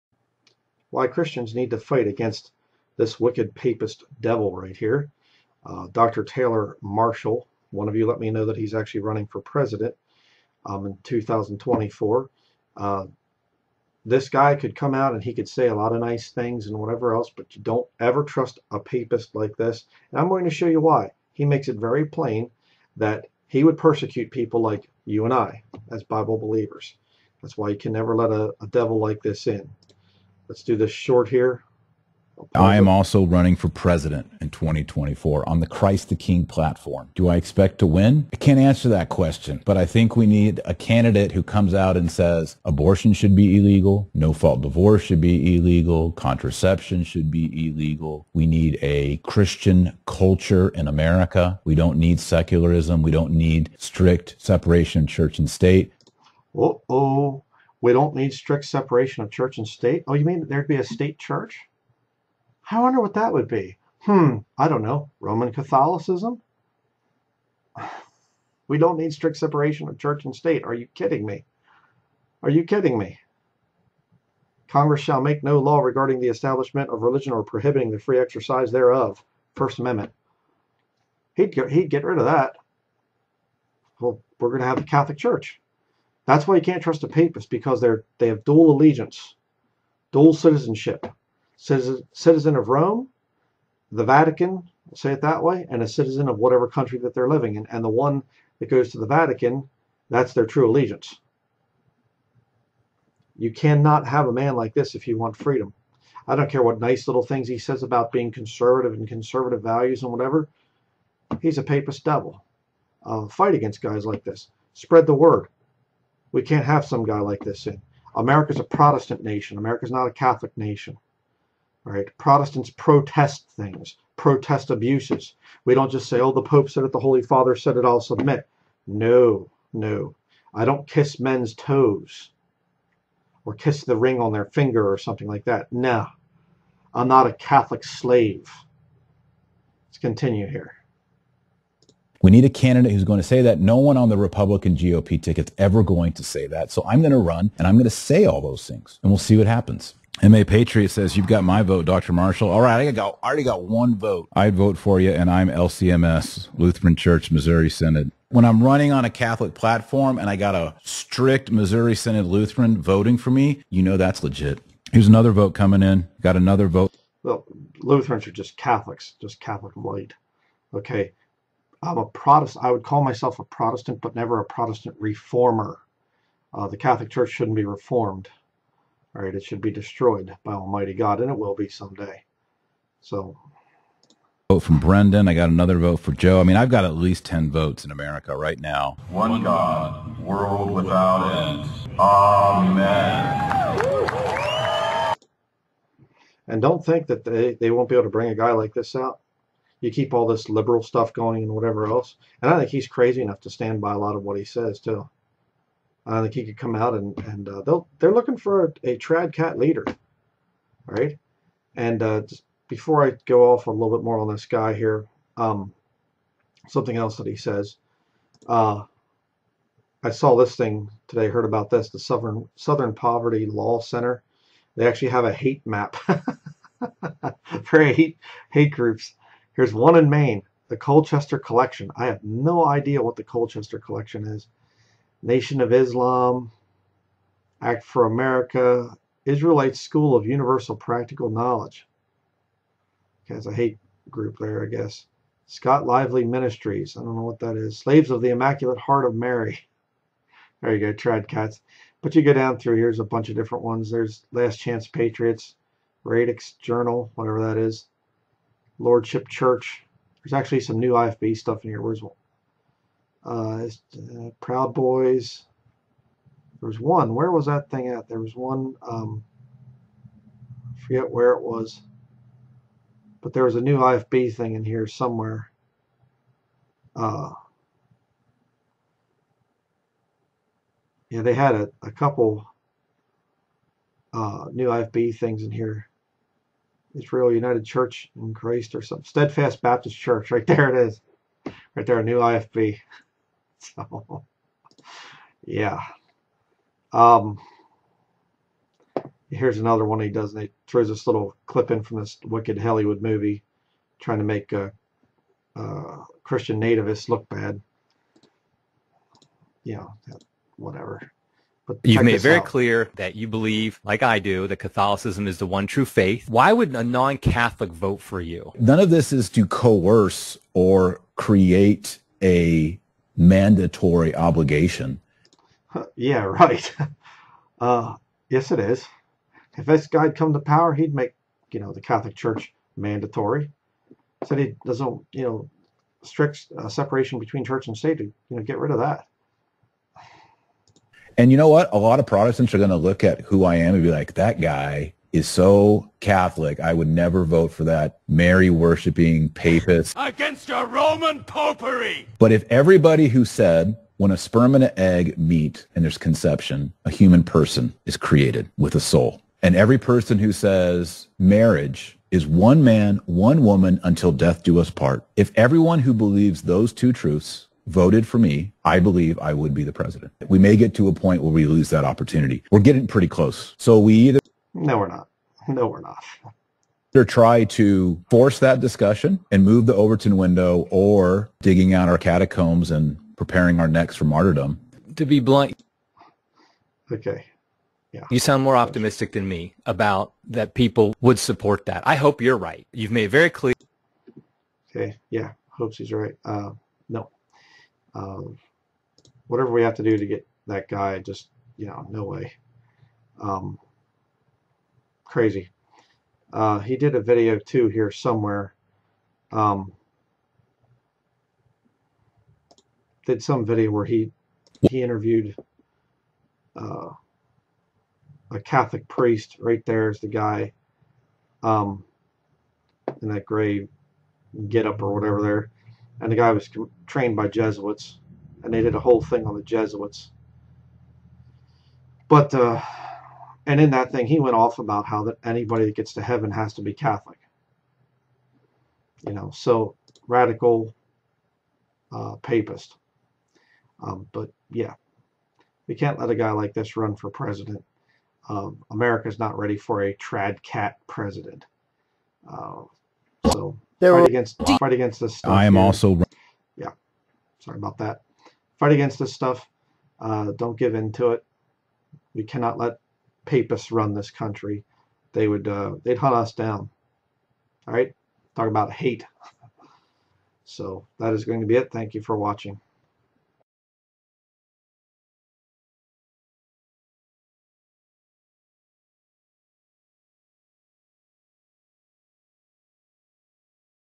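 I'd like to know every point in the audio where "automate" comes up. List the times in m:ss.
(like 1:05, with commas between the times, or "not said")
not said.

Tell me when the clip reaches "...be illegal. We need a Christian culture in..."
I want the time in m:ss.
0:47.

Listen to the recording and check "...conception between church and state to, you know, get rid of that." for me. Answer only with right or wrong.
wrong.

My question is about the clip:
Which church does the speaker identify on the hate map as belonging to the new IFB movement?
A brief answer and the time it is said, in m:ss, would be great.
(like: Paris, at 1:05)
Steadfast Baptist Church, at 4:49.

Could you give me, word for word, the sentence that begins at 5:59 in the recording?
And every person who says marriage is one man, one woman until death do us part.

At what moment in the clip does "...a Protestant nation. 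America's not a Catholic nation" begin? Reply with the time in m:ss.
1:58.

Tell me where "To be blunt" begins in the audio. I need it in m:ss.
6:24.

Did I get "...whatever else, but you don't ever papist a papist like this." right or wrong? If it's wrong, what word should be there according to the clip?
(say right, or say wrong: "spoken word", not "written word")
wrong: "trust", not "papist".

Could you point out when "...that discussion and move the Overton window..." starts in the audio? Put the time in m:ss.
6:18.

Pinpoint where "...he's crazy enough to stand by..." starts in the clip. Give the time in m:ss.
3:22.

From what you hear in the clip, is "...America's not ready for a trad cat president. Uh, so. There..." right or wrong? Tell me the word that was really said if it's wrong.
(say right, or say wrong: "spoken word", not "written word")
right.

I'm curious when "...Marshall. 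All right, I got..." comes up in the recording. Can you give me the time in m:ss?
2:32.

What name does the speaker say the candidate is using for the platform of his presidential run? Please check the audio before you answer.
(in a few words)
Christ the King.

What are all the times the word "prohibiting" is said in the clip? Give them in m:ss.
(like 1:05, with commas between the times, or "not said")
1:17.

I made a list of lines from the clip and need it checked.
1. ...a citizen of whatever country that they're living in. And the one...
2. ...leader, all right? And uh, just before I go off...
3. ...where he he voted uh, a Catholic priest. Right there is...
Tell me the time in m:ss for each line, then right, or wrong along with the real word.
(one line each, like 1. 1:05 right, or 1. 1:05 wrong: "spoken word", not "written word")
1. 1:35 right
2. 3:29 right
3. 6:53 wrong: "interviewed", not "voted".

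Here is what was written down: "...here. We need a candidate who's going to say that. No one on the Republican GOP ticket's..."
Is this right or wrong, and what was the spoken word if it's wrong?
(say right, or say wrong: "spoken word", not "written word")
right.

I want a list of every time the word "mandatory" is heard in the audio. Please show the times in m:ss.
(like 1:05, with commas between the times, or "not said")
5:23, 5:32.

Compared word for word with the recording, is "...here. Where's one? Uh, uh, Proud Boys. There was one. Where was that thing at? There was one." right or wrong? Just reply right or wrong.
right.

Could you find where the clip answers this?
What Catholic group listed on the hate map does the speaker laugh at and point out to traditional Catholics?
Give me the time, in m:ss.
4:07.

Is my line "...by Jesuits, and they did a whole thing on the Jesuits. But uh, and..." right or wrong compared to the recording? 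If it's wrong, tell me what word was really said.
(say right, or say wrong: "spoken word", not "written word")
right.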